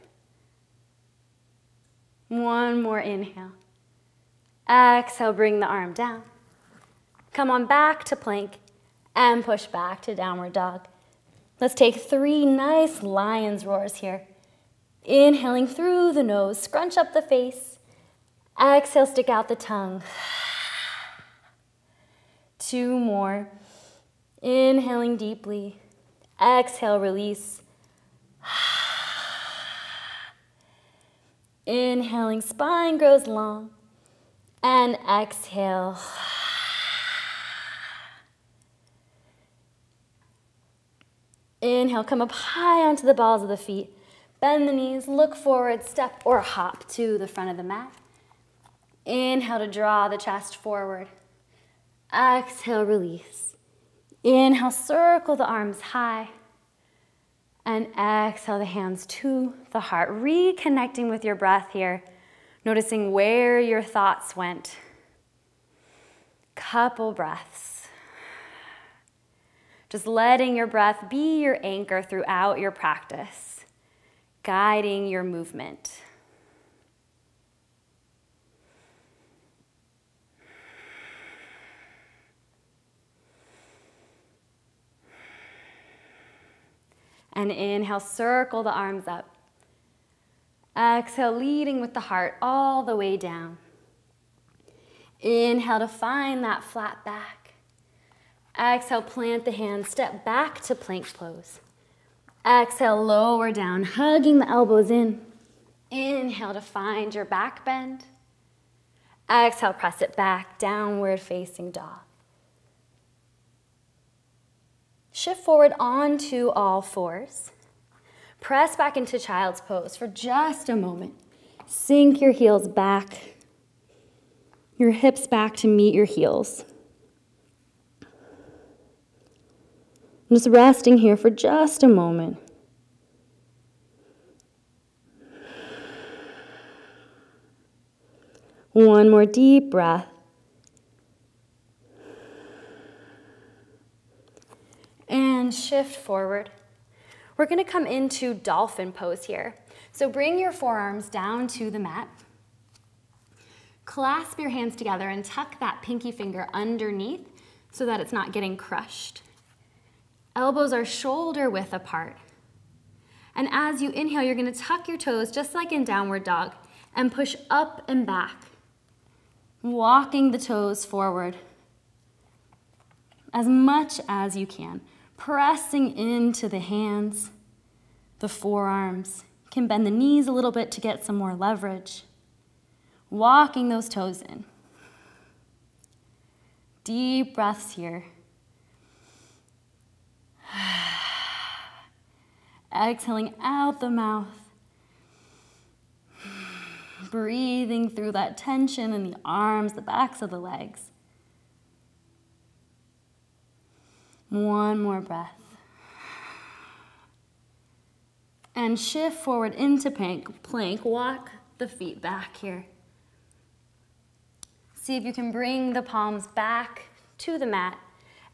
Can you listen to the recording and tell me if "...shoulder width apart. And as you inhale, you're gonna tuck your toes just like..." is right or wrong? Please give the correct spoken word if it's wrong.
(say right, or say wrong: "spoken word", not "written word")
right.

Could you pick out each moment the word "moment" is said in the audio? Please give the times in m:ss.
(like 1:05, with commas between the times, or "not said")
2:00, 2:11.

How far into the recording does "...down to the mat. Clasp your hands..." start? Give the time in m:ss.
2:31.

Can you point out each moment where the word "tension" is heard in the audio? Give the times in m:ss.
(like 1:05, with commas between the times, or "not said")
3:18.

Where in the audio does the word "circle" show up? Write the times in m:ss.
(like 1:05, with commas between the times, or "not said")
0:54, 1:27.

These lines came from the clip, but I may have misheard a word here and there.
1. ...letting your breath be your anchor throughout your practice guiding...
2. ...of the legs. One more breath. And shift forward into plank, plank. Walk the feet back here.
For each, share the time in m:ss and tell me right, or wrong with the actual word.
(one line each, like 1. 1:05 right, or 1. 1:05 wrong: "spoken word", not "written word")
1. 1:10 right
2. 3:20 right.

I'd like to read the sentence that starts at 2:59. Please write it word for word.
Can bend the knees a little bit to get some more leverage.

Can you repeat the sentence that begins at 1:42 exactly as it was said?
Exhale, lower down, hugging the elbows in.